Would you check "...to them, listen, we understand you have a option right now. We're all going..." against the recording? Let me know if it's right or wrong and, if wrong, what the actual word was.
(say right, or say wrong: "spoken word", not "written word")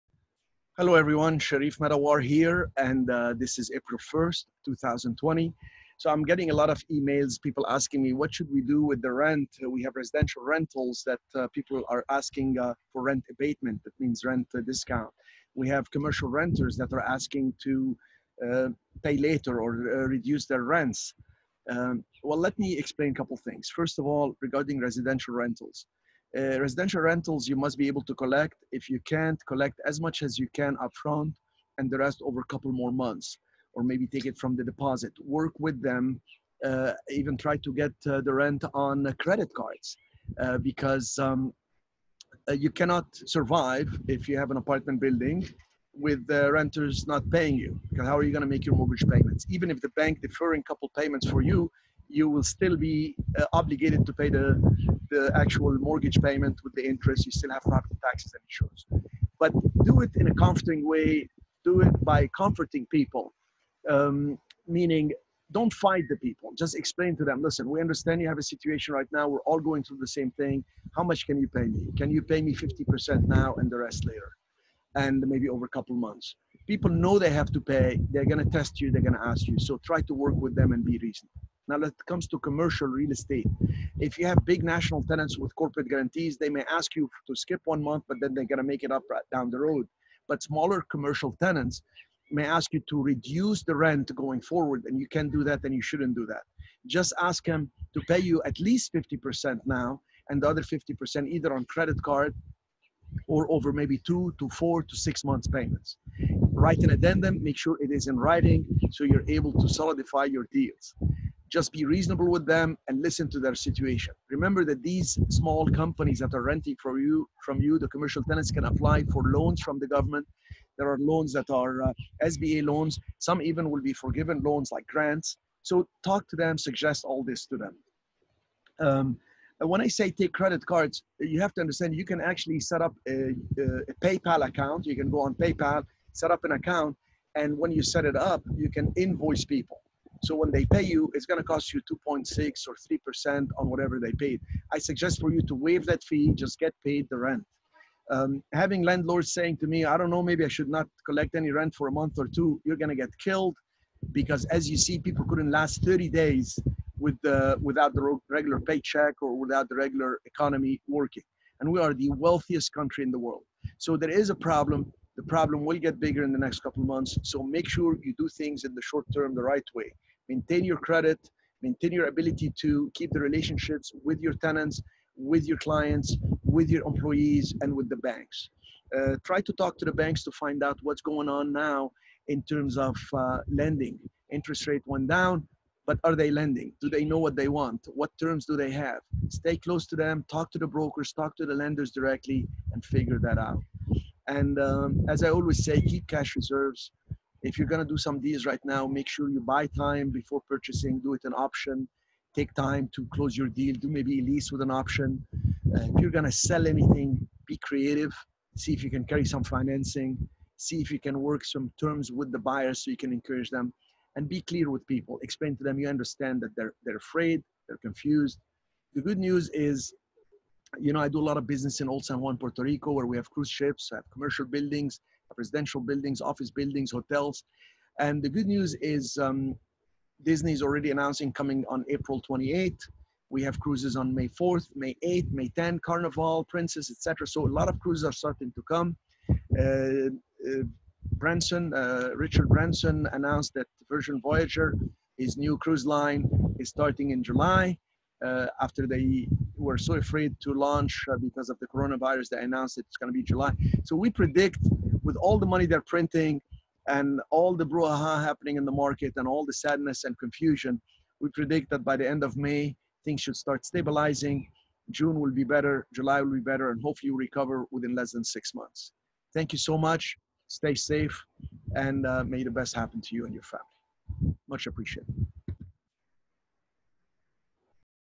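wrong: "situation", not "option".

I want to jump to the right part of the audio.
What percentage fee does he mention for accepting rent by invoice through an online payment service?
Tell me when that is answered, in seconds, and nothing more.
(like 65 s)
141 s.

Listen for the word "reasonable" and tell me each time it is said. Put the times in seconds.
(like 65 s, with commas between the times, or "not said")
80 s, 111 s.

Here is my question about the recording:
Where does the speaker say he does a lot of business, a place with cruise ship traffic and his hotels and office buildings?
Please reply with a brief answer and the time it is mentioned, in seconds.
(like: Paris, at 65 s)
Old San Juan, Puerto Rico, at 221 s.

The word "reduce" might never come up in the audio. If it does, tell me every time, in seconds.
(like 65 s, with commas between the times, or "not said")
20 s, 93 s.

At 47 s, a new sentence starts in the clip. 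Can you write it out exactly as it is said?
Because how are you going to make your mortgage payments?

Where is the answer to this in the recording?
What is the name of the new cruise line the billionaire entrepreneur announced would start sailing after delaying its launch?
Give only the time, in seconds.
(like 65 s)
243 s.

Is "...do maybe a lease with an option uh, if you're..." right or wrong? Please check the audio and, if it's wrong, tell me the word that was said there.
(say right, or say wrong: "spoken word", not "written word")
right.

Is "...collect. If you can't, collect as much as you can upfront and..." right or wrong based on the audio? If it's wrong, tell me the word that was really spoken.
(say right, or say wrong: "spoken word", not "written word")
right.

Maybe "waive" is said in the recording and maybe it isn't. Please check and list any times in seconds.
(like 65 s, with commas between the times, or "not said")
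145 s.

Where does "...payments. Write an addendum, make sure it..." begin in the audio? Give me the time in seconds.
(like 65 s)
105 s.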